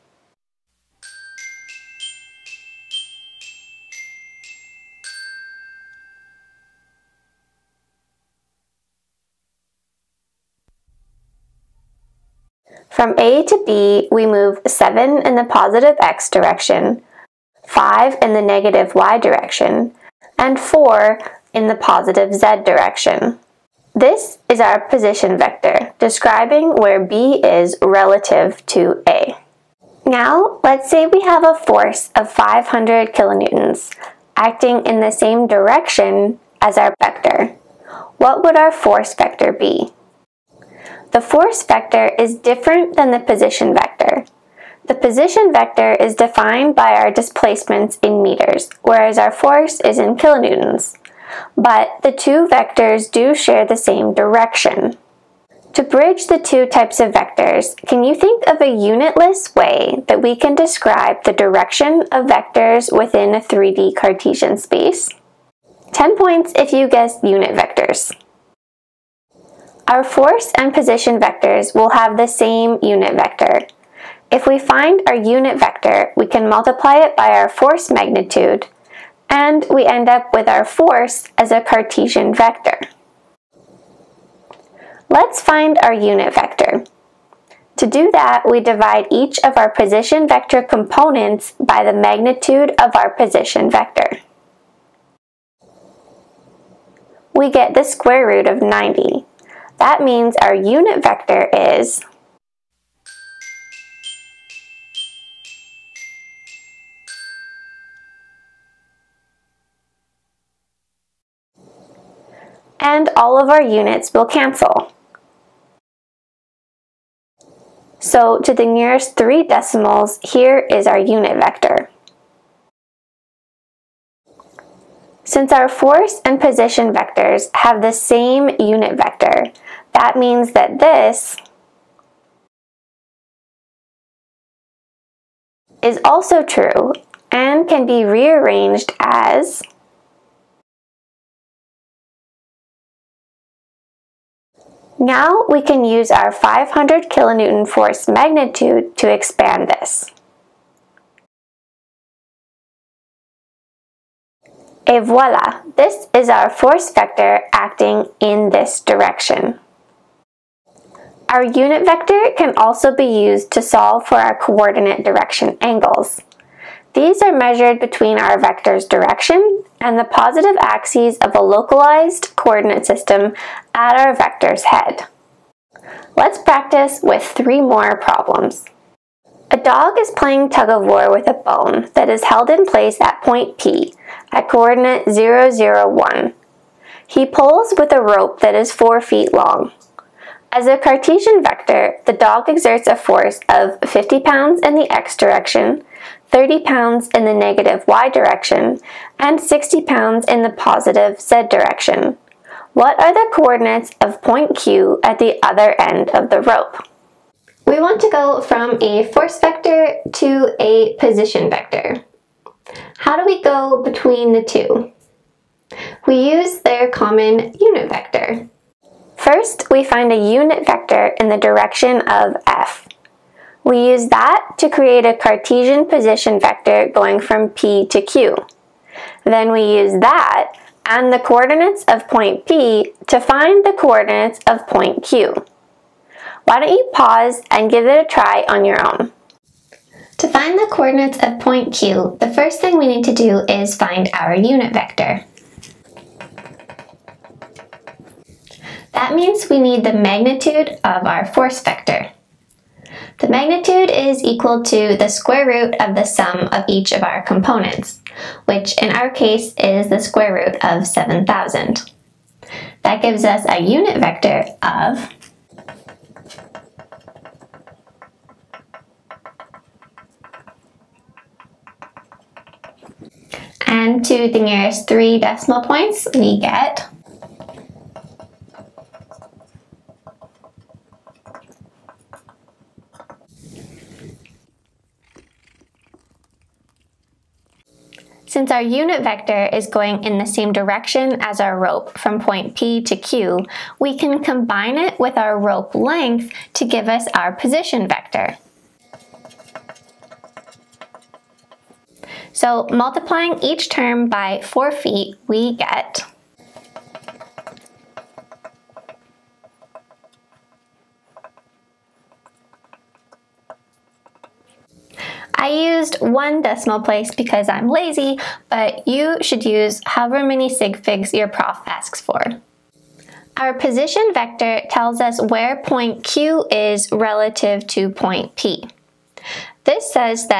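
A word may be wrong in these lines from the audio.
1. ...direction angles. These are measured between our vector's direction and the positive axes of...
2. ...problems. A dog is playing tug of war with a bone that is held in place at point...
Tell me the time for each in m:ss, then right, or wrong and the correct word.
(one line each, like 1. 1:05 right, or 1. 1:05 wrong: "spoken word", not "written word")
1. 2:45 right
2. 2:58 right.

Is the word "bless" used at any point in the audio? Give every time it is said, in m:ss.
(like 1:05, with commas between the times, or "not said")
not said.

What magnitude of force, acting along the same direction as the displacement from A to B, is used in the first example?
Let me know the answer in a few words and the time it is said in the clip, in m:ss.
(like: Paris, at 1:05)
500 kilonewtons, at 0:32.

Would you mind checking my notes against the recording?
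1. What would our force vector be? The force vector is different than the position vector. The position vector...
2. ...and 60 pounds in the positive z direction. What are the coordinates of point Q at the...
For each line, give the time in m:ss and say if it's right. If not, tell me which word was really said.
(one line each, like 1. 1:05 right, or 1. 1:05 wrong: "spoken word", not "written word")
1. 0:38 right
2. 3:19 right.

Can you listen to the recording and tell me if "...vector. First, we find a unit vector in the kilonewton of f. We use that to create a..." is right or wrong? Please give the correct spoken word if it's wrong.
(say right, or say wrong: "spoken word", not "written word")
wrong: "direction", not "kilonewton".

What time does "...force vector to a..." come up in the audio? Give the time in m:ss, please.
3:29.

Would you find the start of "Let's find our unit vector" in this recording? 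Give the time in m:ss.
1:25.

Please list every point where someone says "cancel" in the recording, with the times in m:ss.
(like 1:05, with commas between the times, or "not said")
1:54.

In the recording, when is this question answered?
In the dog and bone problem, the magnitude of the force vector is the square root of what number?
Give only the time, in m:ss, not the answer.
4:20.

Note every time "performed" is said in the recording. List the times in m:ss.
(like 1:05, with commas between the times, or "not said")
not said.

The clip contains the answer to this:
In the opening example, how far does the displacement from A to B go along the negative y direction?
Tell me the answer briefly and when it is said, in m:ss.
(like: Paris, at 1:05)
5, at 0:17.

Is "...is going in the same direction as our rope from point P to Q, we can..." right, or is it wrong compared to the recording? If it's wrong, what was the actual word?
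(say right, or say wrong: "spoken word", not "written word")
right.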